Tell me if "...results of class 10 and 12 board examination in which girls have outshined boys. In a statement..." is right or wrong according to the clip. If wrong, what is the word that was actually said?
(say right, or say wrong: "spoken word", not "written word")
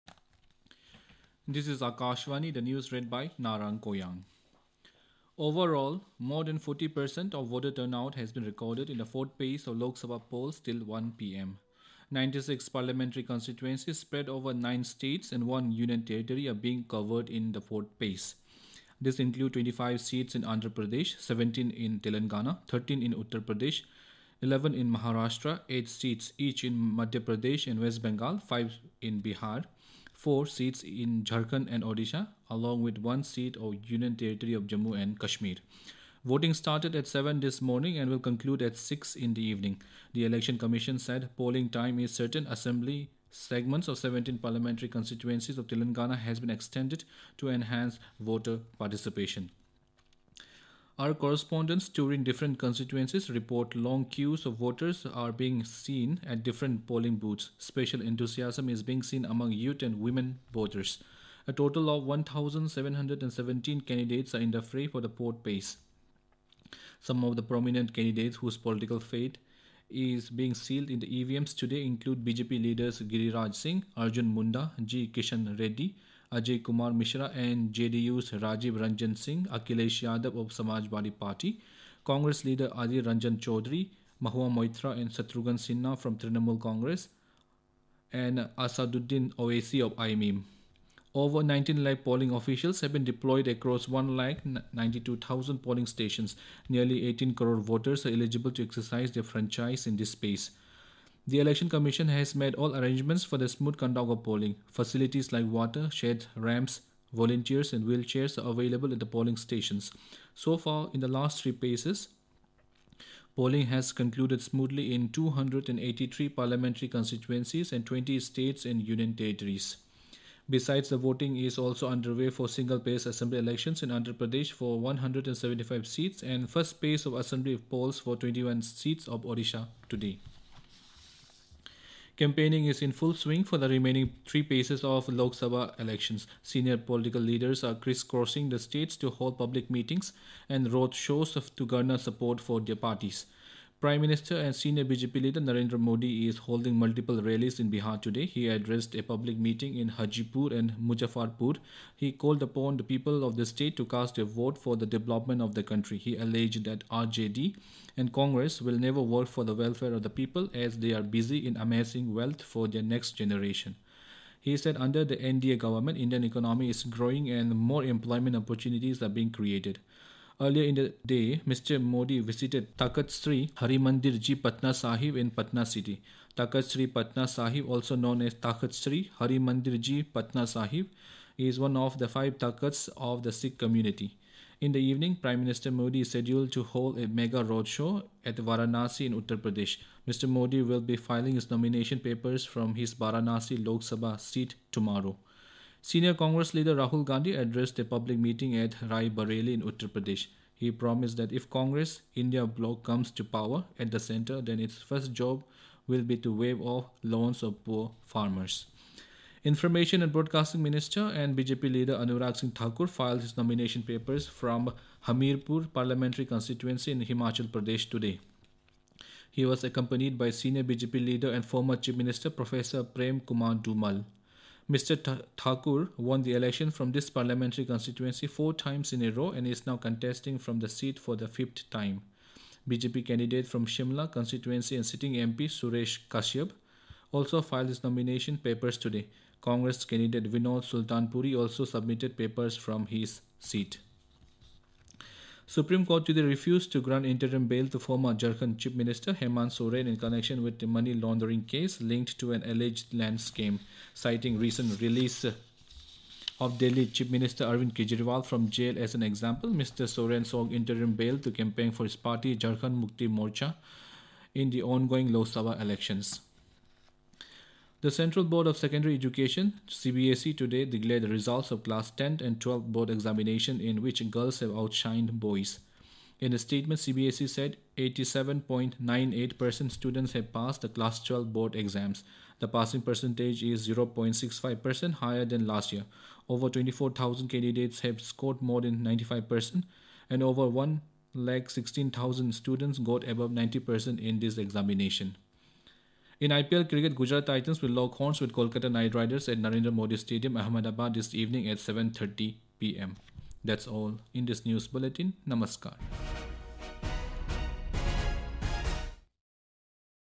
right.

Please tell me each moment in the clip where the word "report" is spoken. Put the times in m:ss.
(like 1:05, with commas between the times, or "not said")
0:53.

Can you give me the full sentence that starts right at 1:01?
A total of 1,717 candidates are in the fray for the port base.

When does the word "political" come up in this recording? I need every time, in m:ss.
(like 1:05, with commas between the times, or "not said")
1:08, 2:16.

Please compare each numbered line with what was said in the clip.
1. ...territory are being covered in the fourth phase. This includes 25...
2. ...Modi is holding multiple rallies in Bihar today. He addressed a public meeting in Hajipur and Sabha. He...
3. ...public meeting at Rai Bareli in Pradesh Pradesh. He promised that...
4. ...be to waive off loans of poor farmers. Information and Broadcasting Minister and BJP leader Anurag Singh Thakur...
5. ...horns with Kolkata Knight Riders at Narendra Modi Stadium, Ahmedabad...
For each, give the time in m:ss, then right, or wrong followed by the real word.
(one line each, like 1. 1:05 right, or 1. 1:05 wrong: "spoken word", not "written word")
1. 0:16 right
2. 2:25 wrong: "Muzaffarpur", not "Sabha"
3. 3:17 wrong: "Uttar", not "Pradesh"
4. 3:26 right
5. 4:57 right.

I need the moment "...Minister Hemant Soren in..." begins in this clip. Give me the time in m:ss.
4:08.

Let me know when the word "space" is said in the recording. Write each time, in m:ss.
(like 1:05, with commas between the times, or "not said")
1:40.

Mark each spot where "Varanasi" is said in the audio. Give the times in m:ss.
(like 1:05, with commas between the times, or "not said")
3:08, 3:12.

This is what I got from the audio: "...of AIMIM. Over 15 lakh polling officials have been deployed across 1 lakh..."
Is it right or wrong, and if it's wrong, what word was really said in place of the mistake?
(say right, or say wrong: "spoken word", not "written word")
wrong: "19", not "15".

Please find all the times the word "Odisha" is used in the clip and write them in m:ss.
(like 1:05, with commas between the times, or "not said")
0:31, 2:09.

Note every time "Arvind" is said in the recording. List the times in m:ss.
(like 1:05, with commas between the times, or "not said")
4:17.